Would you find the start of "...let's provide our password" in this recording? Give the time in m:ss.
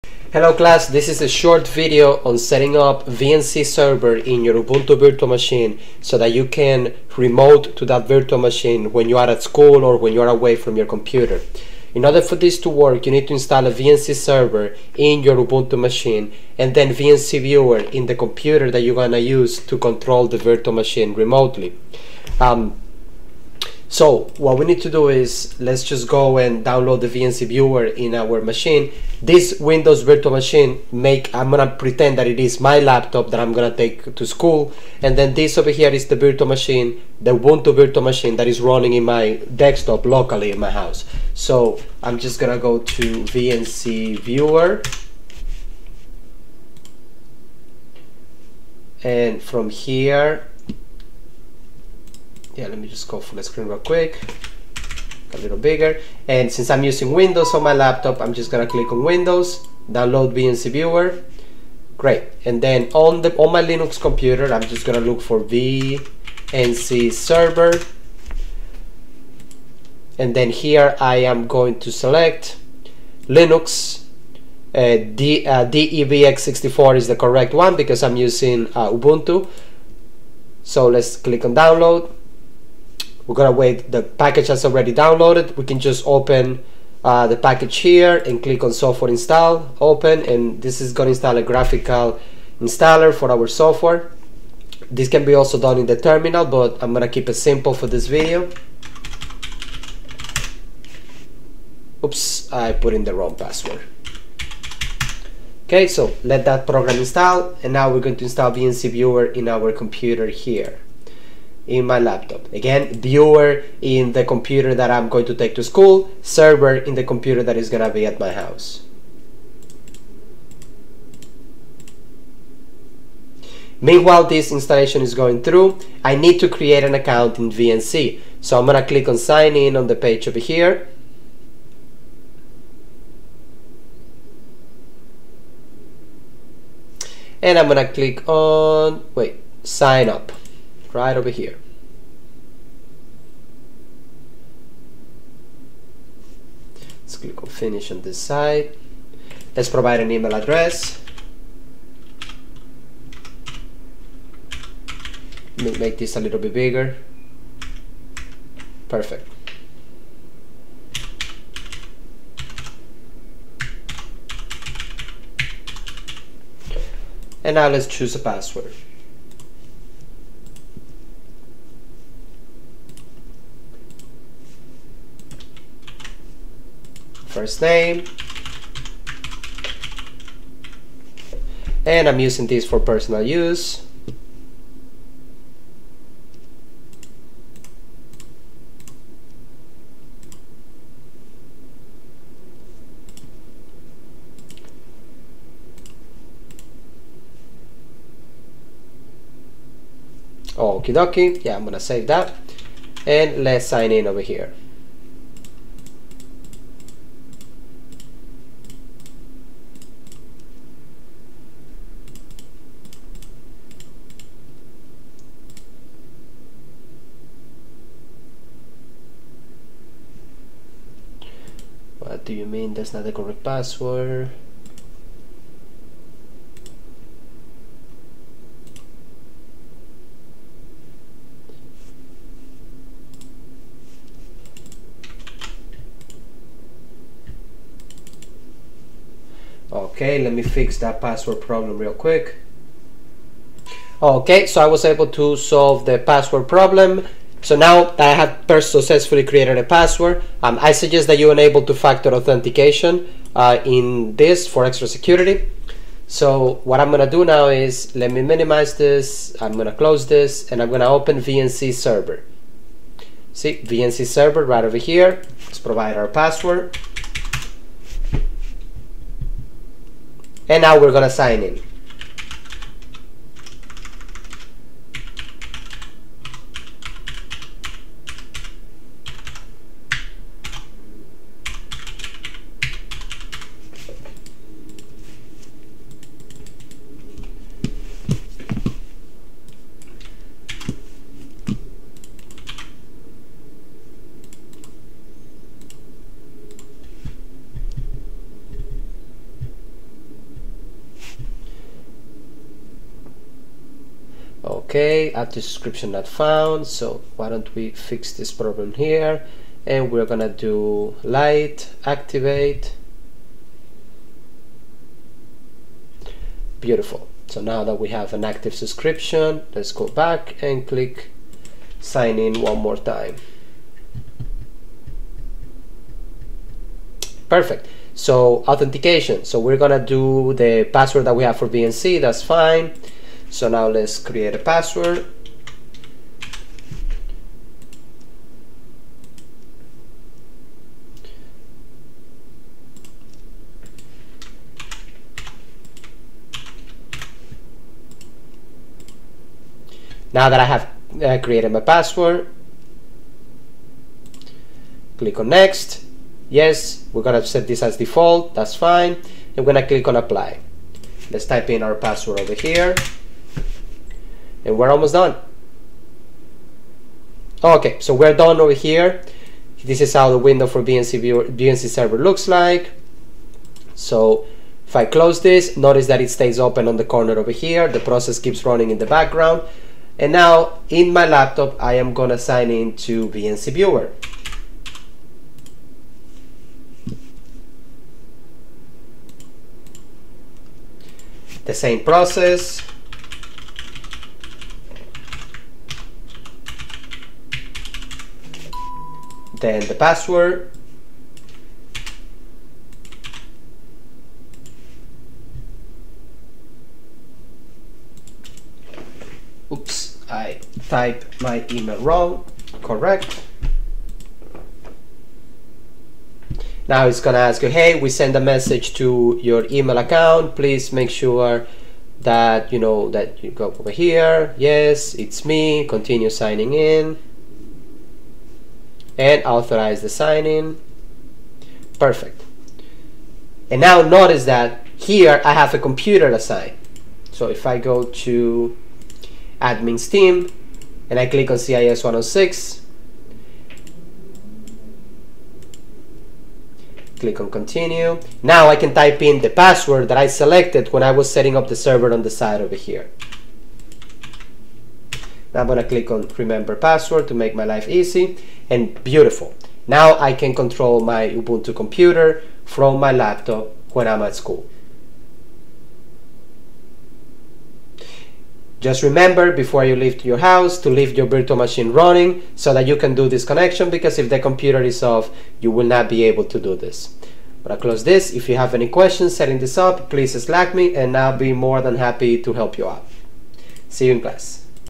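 4:25.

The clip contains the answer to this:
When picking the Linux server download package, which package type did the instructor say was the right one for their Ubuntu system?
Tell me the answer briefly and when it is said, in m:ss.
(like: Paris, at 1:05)
DEB x64, at 1:15.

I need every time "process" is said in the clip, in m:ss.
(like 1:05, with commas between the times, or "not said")
6:17, 6:31.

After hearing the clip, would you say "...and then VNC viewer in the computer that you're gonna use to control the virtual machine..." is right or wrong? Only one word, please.
right.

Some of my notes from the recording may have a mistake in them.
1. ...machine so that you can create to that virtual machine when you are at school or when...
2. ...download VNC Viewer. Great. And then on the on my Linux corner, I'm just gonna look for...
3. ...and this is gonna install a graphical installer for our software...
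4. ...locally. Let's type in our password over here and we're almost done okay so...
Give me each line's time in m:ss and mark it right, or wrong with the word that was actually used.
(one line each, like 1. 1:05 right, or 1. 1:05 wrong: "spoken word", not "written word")
1. 0:05 wrong: "remote", not "create"
2. 0:59 wrong: "computer", not "corner"
3. 1:30 right
4. 5:59 wrong: "apply", not "locally".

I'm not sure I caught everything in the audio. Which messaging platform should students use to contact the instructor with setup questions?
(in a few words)
Slack.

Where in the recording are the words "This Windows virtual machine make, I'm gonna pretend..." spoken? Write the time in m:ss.
0:29.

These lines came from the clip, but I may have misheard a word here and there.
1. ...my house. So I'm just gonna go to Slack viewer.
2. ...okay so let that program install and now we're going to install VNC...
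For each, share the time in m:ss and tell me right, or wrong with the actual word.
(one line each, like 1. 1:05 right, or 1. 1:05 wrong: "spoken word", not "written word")
1. 0:40 wrong: "VNC", not "Slack"
2. 1:45 right.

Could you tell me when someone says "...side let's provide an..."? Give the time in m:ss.
2:28.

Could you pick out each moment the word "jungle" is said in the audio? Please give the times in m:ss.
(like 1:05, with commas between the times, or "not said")
not said.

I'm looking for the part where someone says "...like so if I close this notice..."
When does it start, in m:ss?
6:12.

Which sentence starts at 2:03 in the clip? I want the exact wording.
Meanwhile, this installation is going through, I need to create an account in VNC.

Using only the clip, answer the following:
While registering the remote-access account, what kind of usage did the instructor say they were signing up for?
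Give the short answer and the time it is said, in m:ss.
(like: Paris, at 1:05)
personal use, at 3:02.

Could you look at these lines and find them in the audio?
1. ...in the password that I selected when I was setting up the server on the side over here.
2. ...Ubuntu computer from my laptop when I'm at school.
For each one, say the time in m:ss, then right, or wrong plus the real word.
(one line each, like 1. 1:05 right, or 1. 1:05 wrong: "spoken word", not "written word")
1. 7:29 right
2. 7:41 right.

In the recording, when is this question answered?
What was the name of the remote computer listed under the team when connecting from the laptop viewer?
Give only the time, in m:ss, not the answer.
7:21.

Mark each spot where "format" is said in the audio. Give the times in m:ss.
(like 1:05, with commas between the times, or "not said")
not said.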